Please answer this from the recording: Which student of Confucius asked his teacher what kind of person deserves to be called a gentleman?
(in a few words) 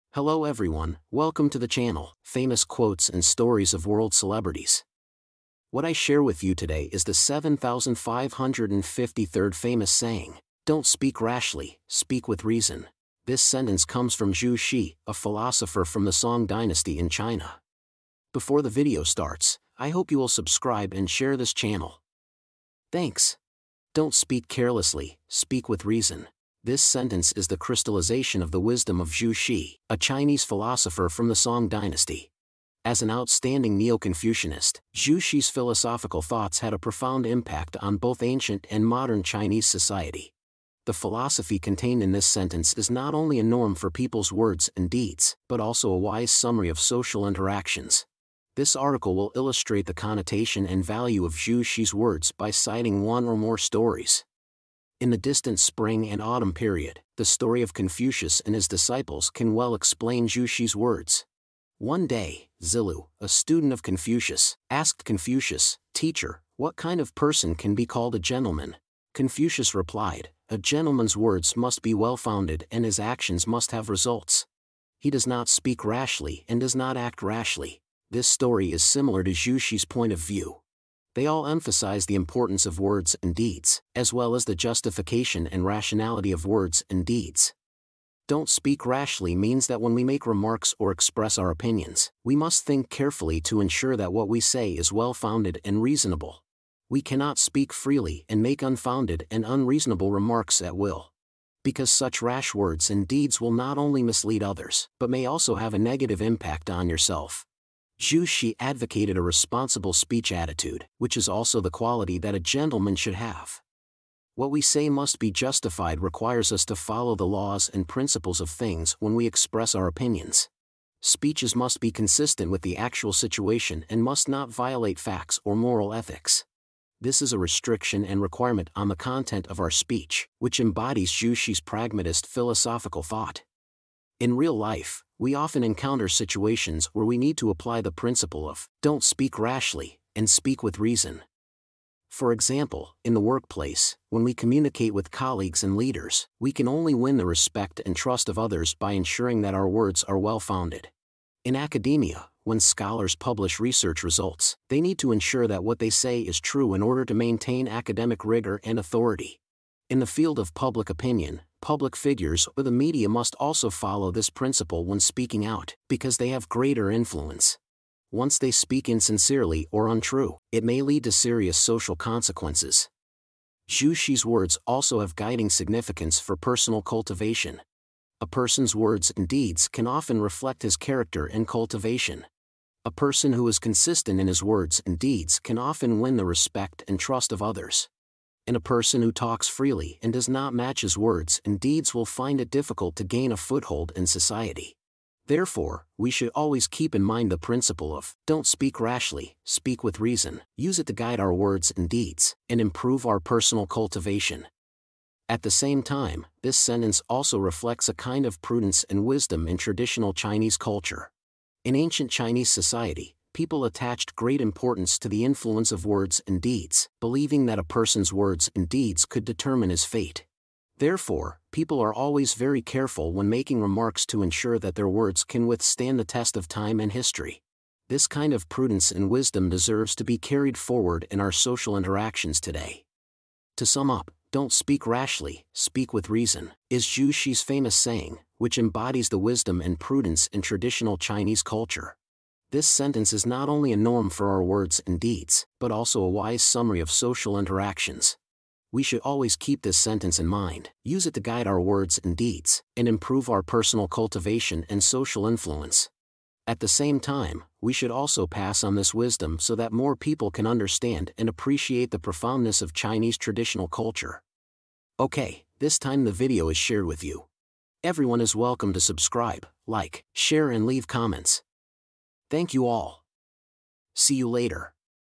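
Zilu.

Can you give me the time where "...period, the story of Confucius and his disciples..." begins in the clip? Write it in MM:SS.
00:56.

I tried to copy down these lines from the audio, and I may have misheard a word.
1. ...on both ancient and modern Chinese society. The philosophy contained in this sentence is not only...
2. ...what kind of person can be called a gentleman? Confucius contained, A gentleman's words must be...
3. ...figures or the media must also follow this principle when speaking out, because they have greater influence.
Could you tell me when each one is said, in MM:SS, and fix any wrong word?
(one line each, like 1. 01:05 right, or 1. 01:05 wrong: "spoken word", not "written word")
1. 00:37 right
2. 01:06 wrong: "replied", not "contained"
3. 02:41 right.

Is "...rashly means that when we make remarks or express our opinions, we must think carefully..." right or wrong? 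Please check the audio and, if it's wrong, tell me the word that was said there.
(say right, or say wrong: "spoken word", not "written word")
right.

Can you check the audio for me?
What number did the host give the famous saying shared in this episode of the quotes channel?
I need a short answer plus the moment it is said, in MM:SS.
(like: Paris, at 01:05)
7,553rd, at 00:07.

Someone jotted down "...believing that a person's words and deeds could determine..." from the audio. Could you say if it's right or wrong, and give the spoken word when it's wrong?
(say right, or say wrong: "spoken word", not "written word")
right.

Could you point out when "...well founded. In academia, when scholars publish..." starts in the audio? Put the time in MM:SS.
02:30.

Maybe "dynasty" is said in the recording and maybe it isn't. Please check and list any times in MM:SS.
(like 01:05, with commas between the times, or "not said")
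00:16, 00:31.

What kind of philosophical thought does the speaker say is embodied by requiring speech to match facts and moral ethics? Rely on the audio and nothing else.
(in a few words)
Pragmatist.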